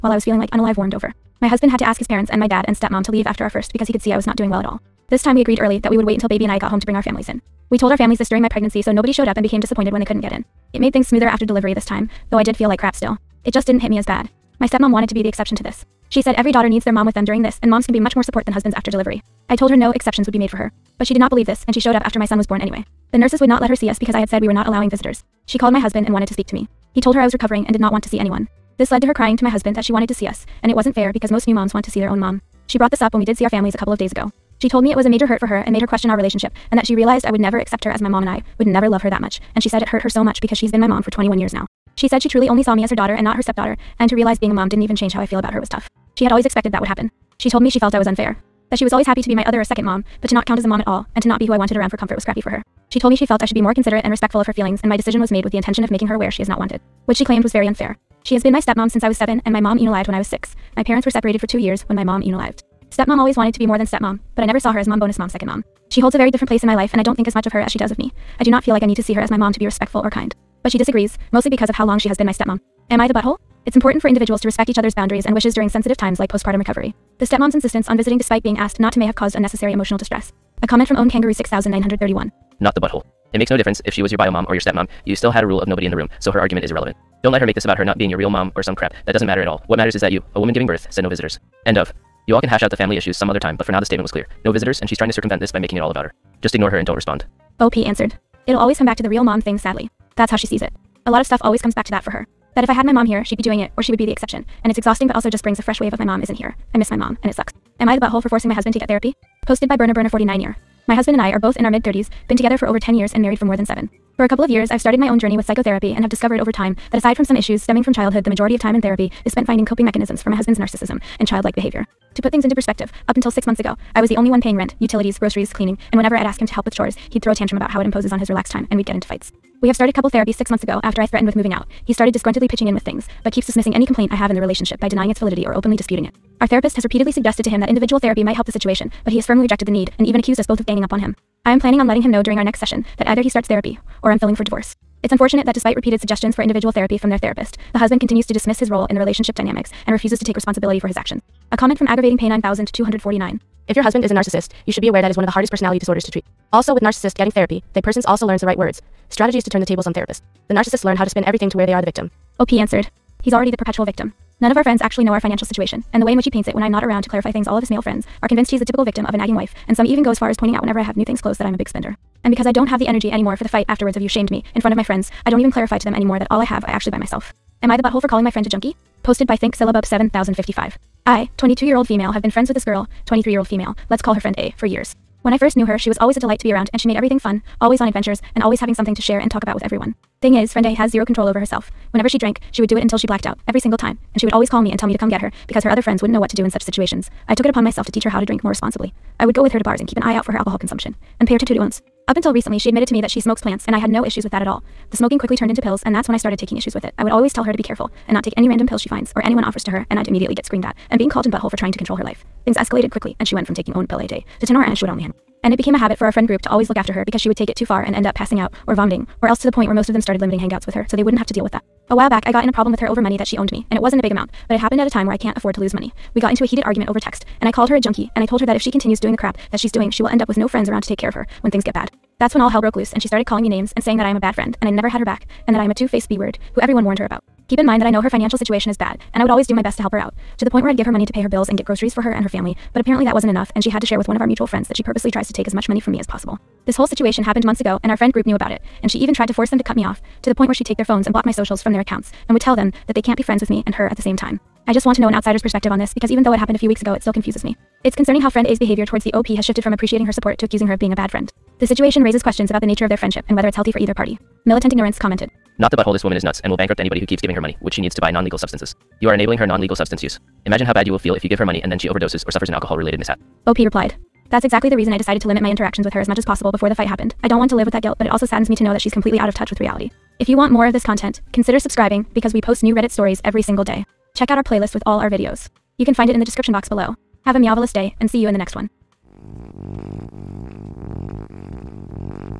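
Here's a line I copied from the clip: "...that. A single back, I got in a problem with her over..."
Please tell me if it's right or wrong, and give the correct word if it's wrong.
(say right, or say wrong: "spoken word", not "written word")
wrong: "while", not "single".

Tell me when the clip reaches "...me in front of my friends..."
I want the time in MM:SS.
02:54.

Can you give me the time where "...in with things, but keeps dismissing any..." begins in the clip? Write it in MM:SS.
02:12.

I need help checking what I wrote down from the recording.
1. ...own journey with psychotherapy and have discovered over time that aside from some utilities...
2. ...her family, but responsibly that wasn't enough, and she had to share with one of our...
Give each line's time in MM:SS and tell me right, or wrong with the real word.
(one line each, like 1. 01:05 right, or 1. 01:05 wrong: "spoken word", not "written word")
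1. 01:55 wrong: "issues", not "utilities"
2. 04:02 wrong: "apparently", not "responsibly".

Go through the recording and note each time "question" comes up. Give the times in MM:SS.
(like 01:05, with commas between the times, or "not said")
00:35, 04:22.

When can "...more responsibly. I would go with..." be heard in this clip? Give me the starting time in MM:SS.
03:18.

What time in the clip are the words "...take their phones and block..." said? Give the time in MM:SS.
04:10.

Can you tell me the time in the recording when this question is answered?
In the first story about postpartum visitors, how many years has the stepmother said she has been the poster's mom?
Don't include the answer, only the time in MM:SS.
00:41.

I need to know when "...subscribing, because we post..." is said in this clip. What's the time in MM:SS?
04:41.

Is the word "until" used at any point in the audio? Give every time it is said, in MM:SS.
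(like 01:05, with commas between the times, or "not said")
00:06, 02:03, 03:12, 03:22.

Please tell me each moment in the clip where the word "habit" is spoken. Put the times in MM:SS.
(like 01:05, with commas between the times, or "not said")
03:35.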